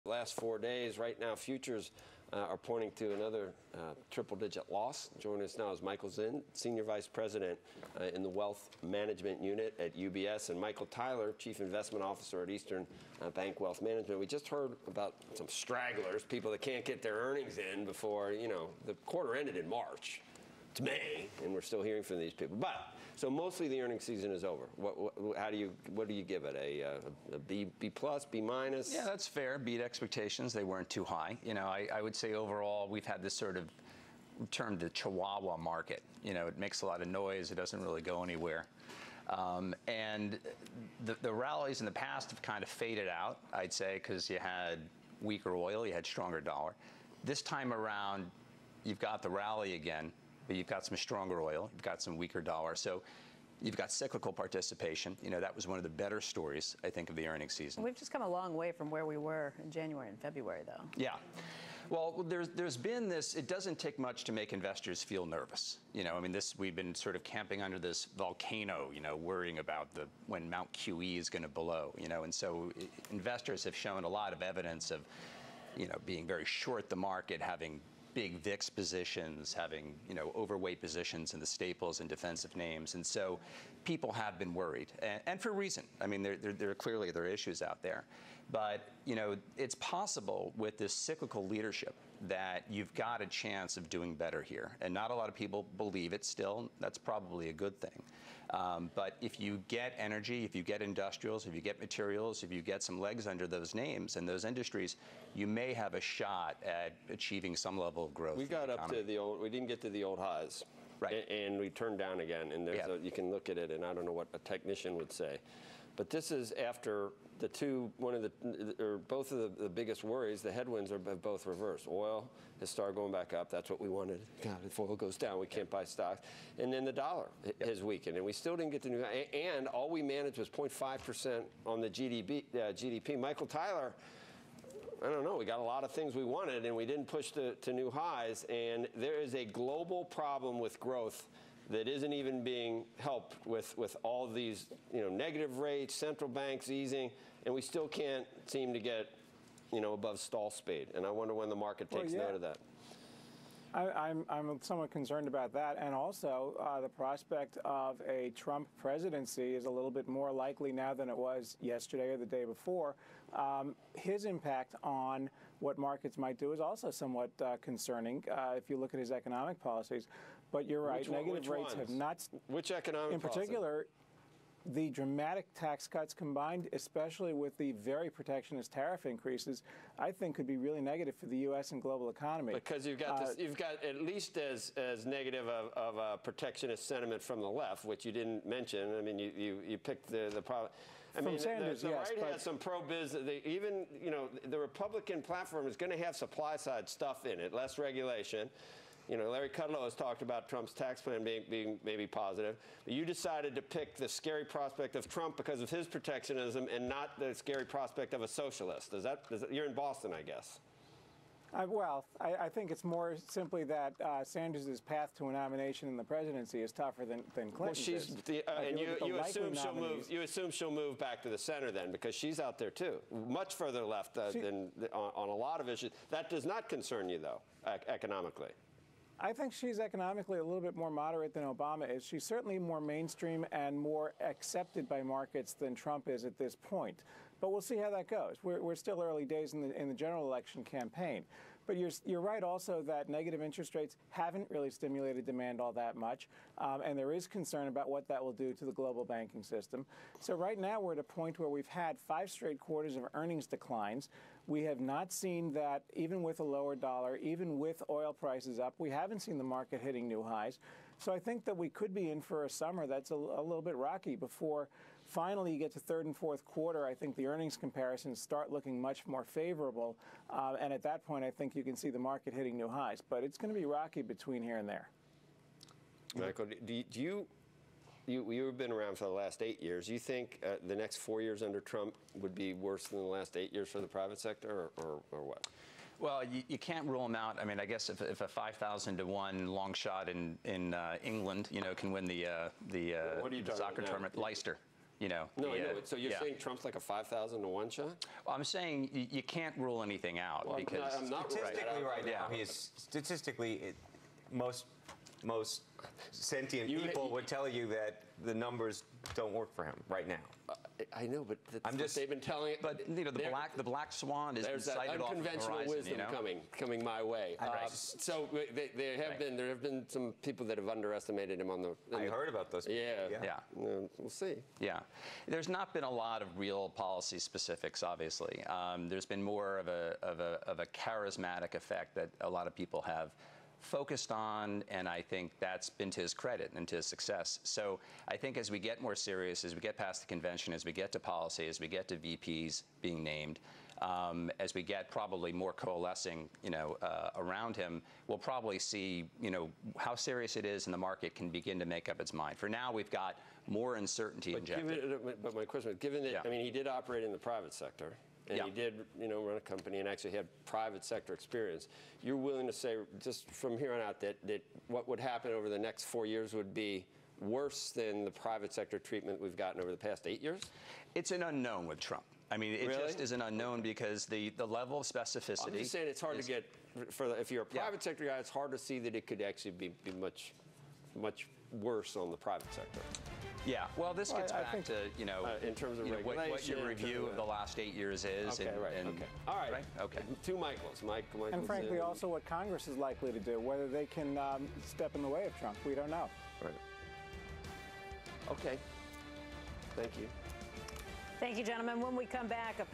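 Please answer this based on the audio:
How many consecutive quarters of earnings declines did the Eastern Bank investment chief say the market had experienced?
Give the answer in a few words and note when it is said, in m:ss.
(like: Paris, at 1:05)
5, at 4:12.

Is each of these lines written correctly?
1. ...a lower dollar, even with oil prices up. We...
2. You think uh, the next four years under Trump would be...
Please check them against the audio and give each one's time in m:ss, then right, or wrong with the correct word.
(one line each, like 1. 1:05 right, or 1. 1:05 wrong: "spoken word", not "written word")
1. 4:16 right
2. 4:39 right.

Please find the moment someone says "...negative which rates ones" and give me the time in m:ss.
2:51.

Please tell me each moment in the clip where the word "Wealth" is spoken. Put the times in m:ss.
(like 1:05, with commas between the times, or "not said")
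0:08, 0:13.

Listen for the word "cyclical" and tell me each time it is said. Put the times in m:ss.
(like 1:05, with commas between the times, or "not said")
0:53, 1:30.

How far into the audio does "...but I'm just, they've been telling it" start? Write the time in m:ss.
5:11.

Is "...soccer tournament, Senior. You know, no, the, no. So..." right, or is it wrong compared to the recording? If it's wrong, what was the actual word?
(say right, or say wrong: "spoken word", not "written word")
wrong: "Leicester", not "Senior".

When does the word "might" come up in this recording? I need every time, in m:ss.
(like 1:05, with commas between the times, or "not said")
2:46.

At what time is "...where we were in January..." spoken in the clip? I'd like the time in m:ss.
0:58.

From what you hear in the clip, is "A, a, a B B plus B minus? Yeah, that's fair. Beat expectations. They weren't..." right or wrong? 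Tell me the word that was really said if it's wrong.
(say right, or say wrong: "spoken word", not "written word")
right.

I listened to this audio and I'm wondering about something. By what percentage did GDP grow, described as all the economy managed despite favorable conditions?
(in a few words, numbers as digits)
0.5%.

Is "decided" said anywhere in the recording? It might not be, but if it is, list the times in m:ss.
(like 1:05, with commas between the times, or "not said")
3:23.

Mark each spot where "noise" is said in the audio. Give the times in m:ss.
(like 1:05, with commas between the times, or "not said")
0:37.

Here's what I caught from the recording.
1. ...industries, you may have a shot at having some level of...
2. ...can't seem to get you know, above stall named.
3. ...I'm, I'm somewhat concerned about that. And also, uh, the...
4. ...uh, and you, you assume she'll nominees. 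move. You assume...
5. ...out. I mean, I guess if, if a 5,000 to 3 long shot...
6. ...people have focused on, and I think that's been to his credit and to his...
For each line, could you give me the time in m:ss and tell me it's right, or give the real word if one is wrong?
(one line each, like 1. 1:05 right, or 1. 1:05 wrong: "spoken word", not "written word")
1. 1:44 wrong: "achieving", not "having"
2. 2:27 wrong: "speed", not "named"
3. 2:34 right
4. 3:38 right
5. 4:47 wrong: "1", not "3"
6. 5:32 right.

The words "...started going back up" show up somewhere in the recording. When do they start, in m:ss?
2:02.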